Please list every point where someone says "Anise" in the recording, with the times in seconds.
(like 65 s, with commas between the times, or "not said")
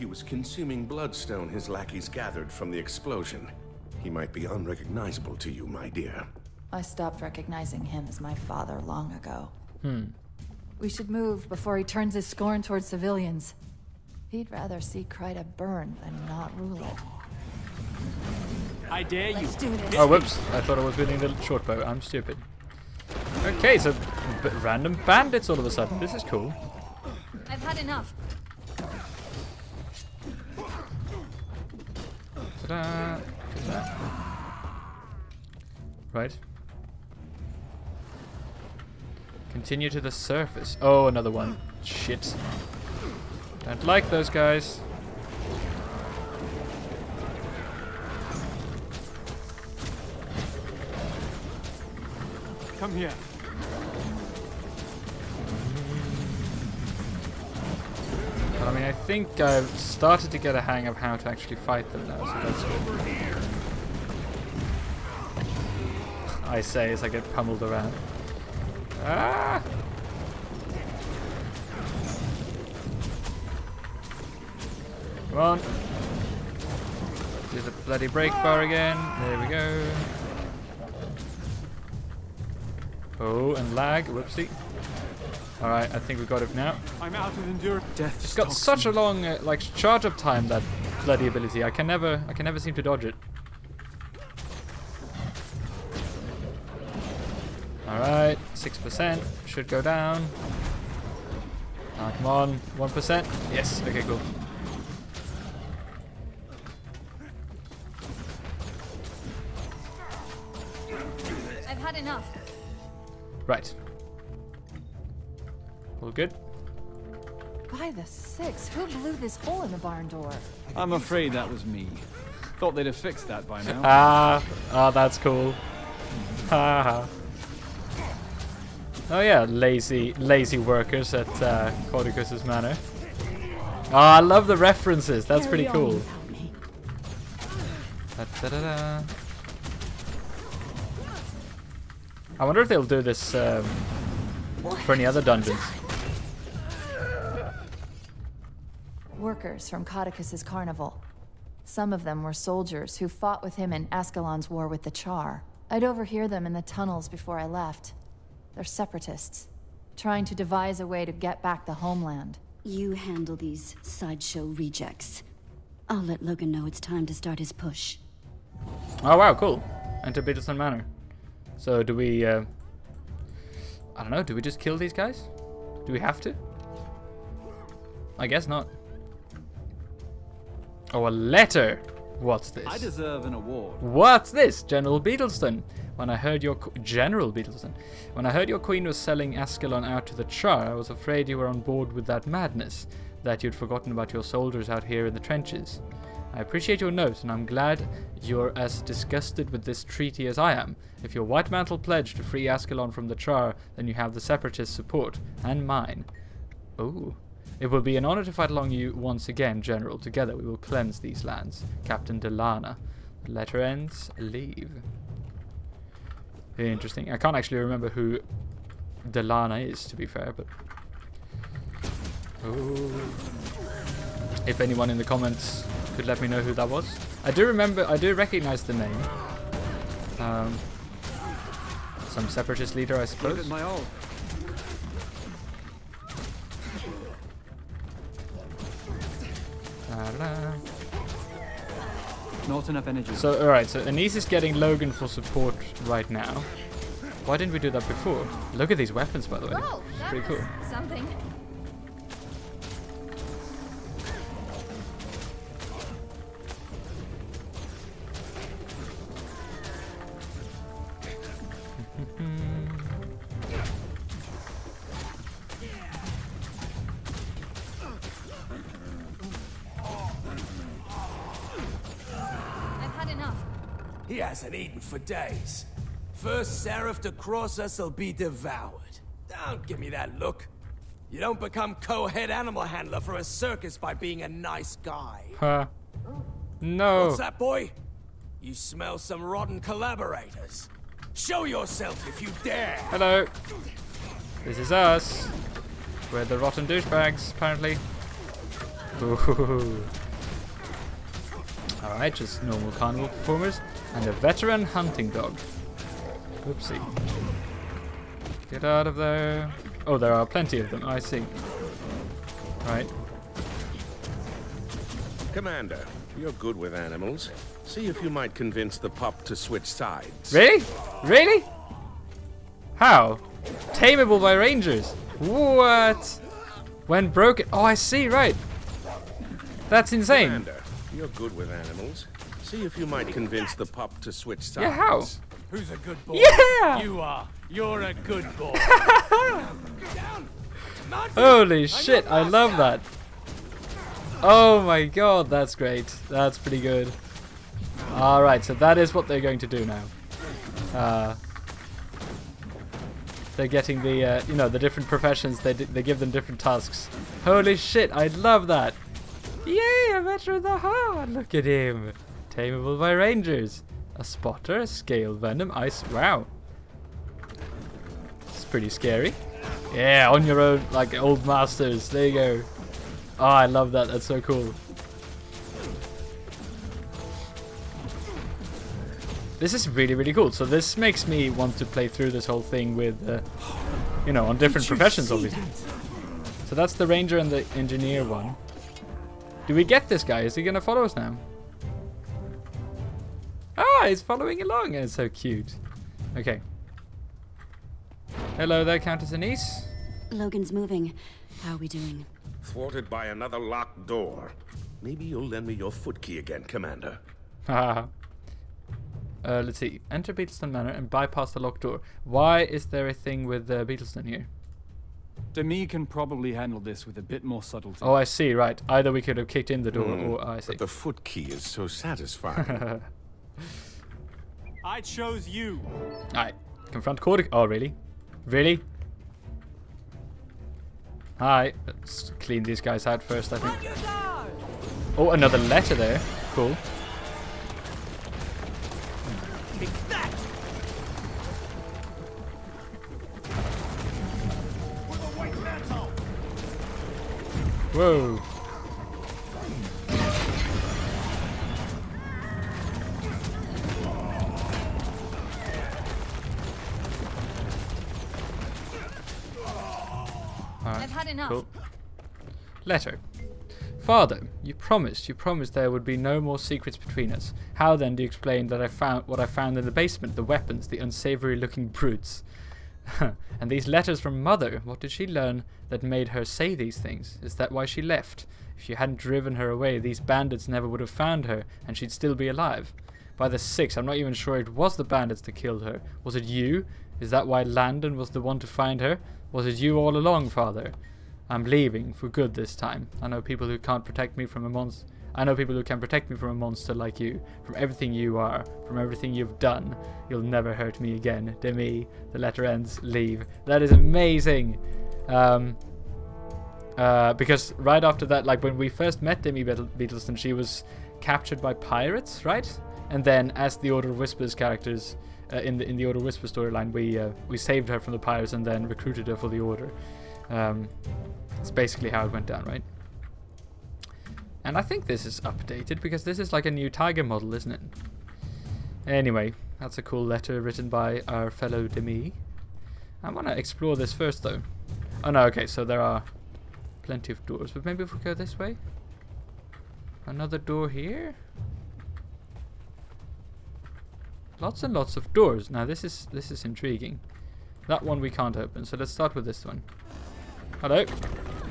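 243 s, 399 s.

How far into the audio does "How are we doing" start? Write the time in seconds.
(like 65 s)
401 s.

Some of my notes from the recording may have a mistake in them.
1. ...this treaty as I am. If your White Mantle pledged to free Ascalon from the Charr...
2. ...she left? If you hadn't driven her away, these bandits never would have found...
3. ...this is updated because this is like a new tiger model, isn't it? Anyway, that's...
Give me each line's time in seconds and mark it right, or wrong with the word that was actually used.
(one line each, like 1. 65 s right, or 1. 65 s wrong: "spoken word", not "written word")
1. 199 s right
2. 477 s right
3. 524 s right.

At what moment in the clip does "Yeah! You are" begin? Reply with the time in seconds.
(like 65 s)
336 s.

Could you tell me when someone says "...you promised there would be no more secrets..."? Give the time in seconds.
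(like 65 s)
465 s.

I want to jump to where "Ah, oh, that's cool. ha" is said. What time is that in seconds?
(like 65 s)
123 s.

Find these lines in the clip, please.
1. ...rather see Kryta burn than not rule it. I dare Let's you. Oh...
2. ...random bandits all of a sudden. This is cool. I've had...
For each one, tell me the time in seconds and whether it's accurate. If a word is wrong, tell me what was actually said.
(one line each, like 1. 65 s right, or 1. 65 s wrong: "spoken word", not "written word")
1. 14 s right
2. 24 s right.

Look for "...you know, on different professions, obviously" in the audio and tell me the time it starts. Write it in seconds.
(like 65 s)
384 s.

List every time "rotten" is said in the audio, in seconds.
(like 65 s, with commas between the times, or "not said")
289 s, 296 s.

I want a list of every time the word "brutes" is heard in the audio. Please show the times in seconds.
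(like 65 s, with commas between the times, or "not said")
471 s.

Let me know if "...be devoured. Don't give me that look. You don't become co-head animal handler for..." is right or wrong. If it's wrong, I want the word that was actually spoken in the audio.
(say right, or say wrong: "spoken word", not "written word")
right.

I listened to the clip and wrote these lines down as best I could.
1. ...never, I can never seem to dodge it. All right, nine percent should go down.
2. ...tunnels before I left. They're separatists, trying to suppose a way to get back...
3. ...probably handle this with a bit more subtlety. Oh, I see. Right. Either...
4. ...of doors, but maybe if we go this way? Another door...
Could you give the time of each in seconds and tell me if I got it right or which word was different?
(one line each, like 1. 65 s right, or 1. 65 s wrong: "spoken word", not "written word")
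1. 91 s wrong: "six", not "nine"
2. 156 s wrong: "devise", not "suppose"
3. 415 s right
4. 537 s right.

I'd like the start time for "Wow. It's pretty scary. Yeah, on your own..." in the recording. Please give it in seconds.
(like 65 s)
365 s.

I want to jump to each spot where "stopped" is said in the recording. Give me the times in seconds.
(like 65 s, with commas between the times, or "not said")
6 s.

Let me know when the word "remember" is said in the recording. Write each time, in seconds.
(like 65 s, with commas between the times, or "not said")
217 s, 227 s.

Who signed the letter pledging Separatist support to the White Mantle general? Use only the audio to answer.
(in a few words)
Captain Delana.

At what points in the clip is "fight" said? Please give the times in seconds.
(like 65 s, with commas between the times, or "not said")
61 s, 208 s.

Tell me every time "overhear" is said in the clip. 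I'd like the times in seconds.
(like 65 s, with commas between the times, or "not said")
155 s.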